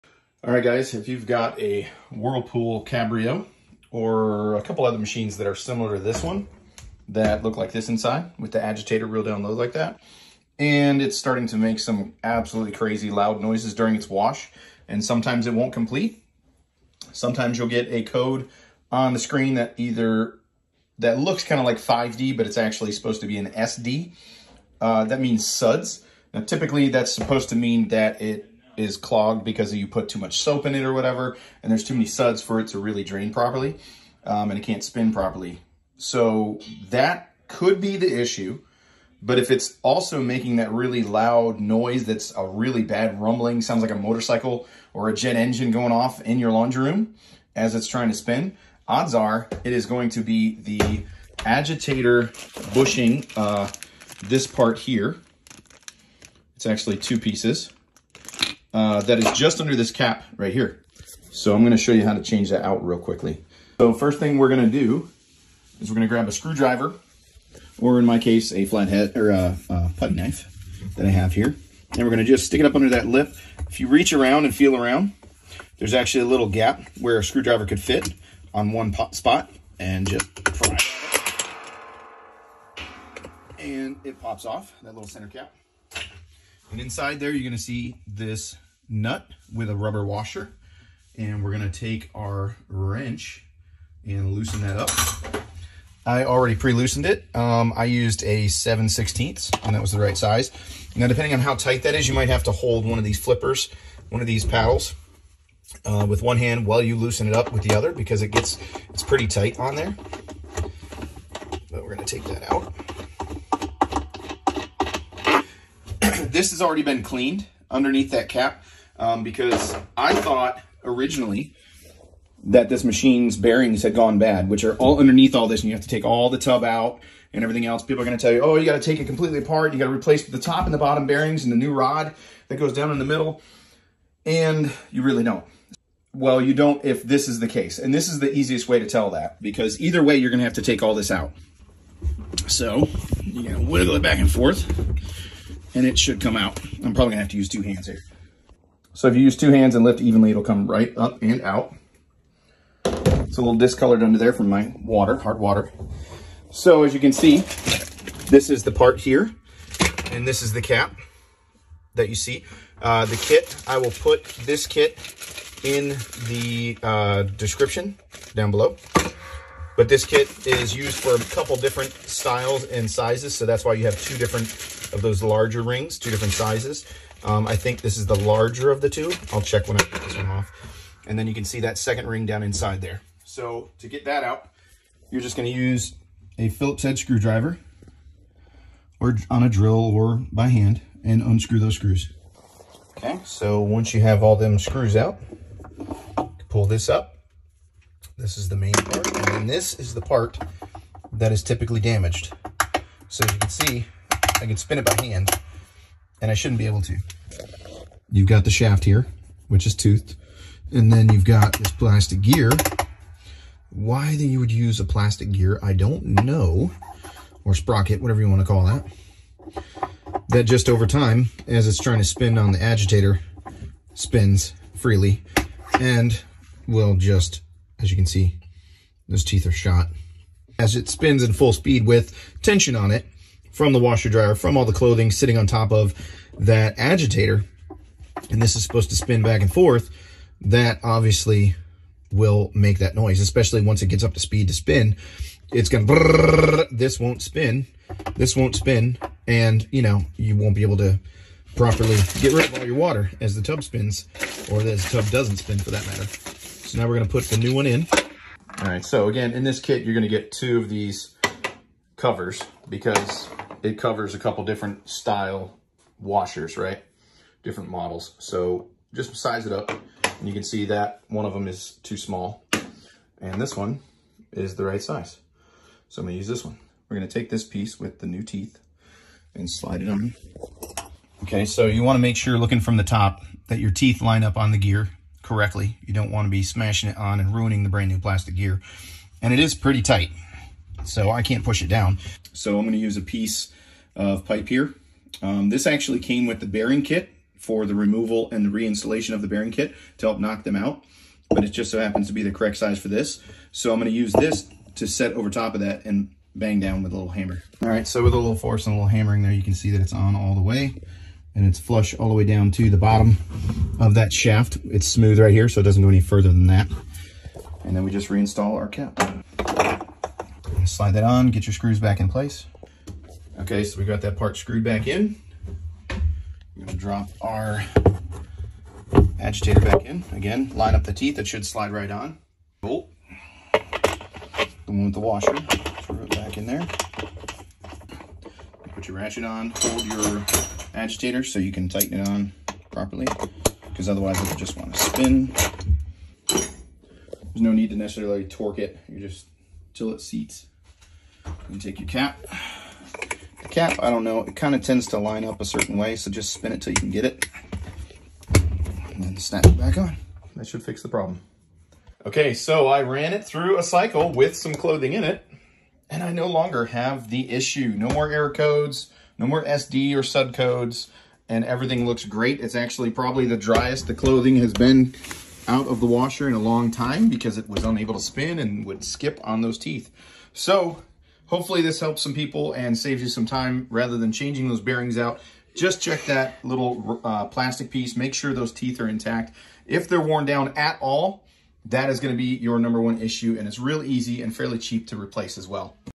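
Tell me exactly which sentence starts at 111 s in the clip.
But we're gonna take that out.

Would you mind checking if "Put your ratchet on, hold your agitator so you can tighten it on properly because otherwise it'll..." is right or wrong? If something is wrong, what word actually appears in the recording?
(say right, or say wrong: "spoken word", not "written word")
right.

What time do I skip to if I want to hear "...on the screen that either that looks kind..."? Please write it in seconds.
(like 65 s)
18 s.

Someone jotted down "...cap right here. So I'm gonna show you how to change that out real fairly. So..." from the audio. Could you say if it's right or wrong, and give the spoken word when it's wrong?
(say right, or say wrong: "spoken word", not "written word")
wrong: "quickly", not "fairly".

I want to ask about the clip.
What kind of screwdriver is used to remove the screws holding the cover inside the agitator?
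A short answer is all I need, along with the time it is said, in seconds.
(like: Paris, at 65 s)
Phillips head, at 186 s.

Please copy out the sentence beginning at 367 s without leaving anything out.
No more error codes, no more SD or sud codes and everything looks great.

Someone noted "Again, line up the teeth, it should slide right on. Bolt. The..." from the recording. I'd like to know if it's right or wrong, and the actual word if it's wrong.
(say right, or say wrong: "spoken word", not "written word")
right.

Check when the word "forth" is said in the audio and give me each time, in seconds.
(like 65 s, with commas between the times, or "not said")
144 s, 239 s.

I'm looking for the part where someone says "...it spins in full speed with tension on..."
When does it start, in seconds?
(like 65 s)
230 s.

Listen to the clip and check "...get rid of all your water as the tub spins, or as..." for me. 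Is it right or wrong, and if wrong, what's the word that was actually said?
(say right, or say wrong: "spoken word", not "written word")
right.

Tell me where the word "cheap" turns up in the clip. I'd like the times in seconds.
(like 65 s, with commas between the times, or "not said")
394 s.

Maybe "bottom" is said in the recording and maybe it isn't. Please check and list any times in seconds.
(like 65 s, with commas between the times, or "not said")
130 s, 312 s.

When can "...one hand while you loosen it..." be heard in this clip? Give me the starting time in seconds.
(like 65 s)
106 s.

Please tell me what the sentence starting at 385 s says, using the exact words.
Just check that little uh, plastic piece.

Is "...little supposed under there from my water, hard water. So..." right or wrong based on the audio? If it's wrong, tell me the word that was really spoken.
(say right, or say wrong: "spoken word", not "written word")
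wrong: "discolored", not "supposed".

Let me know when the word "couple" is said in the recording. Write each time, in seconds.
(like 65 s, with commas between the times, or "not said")
4 s, 171 s, 264 s.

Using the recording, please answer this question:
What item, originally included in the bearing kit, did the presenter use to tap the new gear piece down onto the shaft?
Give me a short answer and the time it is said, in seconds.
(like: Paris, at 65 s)
Piece of pipe, at 293 s.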